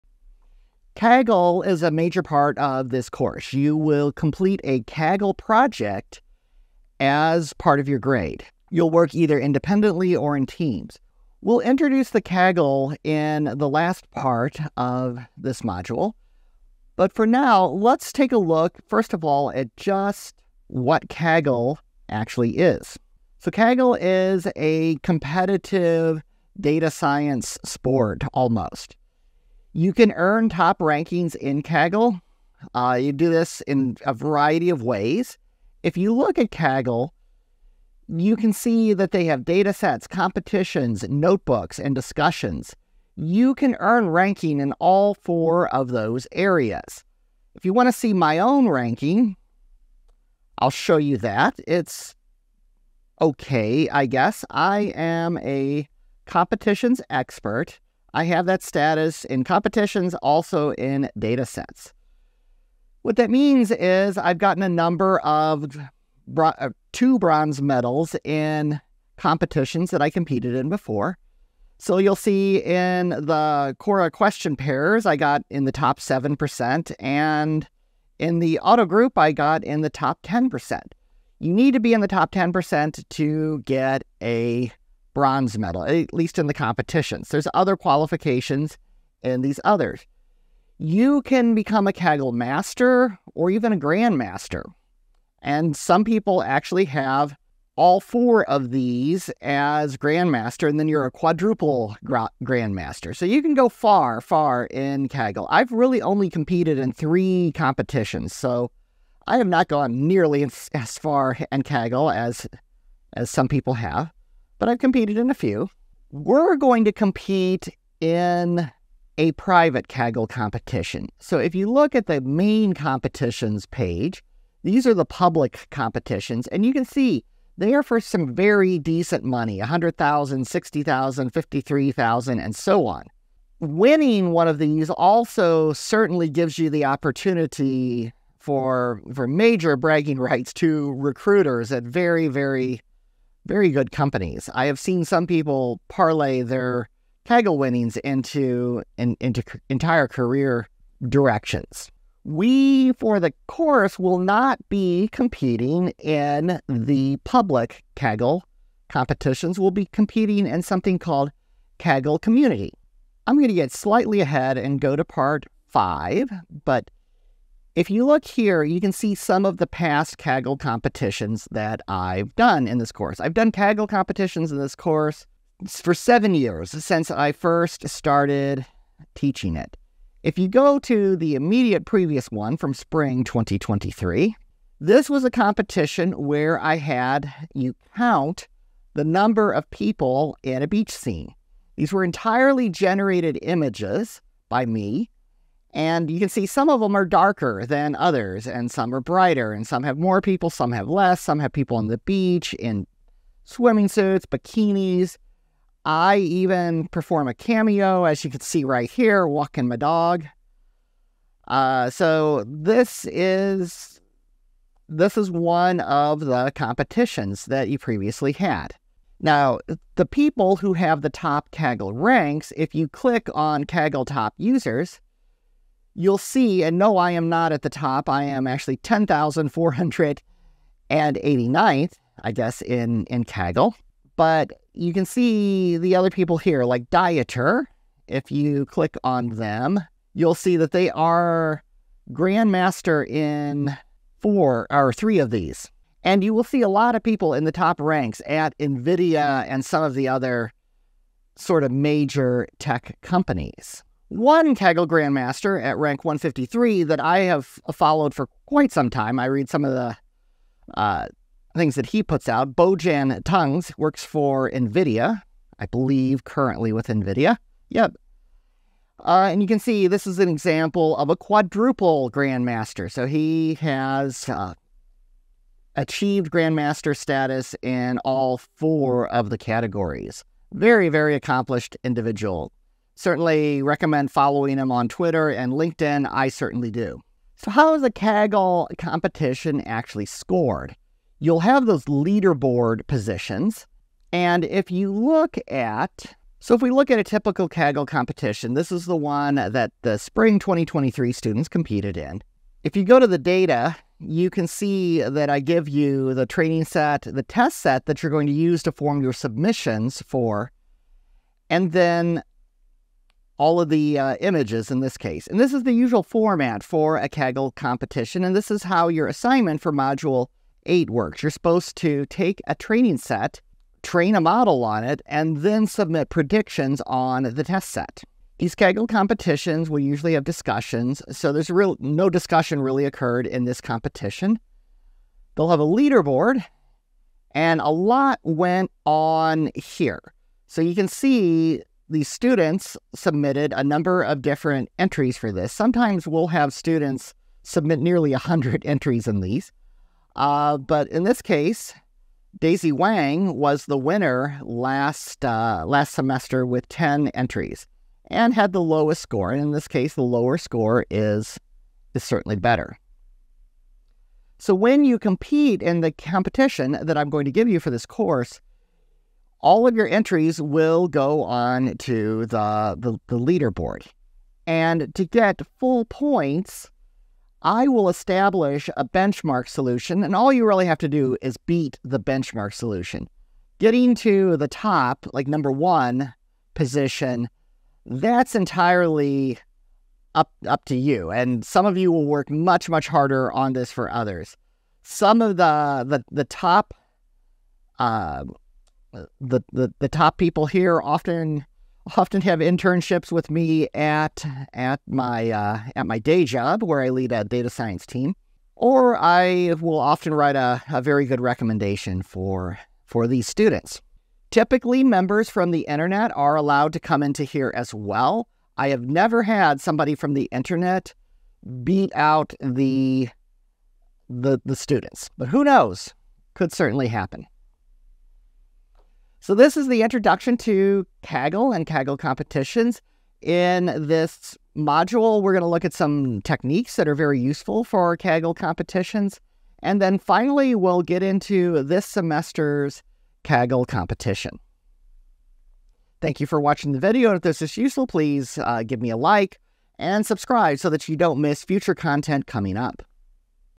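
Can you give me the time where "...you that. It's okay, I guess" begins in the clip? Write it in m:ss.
0:50.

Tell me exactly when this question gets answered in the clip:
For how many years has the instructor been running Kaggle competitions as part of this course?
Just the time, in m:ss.
2:55.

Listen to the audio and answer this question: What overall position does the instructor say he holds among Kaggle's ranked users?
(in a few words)
10,489th.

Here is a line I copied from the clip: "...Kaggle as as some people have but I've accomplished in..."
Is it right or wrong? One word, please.
wrong.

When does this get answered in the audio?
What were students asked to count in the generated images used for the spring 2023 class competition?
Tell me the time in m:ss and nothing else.
3:08.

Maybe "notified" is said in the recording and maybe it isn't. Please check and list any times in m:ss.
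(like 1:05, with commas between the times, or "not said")
not said.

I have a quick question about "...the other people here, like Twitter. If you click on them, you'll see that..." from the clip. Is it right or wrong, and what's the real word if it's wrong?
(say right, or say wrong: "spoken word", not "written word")
wrong: "Dieter", not "Twitter".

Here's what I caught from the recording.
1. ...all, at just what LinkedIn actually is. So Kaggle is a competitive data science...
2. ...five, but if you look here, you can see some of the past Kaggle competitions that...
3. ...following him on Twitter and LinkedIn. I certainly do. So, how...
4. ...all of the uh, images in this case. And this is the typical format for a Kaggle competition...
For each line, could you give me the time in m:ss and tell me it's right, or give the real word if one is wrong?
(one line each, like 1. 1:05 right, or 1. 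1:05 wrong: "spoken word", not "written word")
1. 0:19 wrong: "Kaggle", not "LinkedIn"
2. 2:45 right
3. 4:44 right
4. 5:13 wrong: "usual", not "typical".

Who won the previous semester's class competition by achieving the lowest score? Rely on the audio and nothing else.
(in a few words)
Daisy Wang.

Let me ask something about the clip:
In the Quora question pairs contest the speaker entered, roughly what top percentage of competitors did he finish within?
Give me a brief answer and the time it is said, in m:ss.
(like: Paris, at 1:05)
top 7%, at 1:15.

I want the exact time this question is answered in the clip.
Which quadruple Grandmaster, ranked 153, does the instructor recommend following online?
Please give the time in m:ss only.
4:22.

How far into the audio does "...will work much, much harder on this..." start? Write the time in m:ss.
6:31.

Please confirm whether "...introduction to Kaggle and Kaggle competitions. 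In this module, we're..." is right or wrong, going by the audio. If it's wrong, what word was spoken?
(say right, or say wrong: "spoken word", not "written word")
right.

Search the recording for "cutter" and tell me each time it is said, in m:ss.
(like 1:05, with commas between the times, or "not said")
not said.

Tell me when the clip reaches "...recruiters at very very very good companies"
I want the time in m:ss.
2:20.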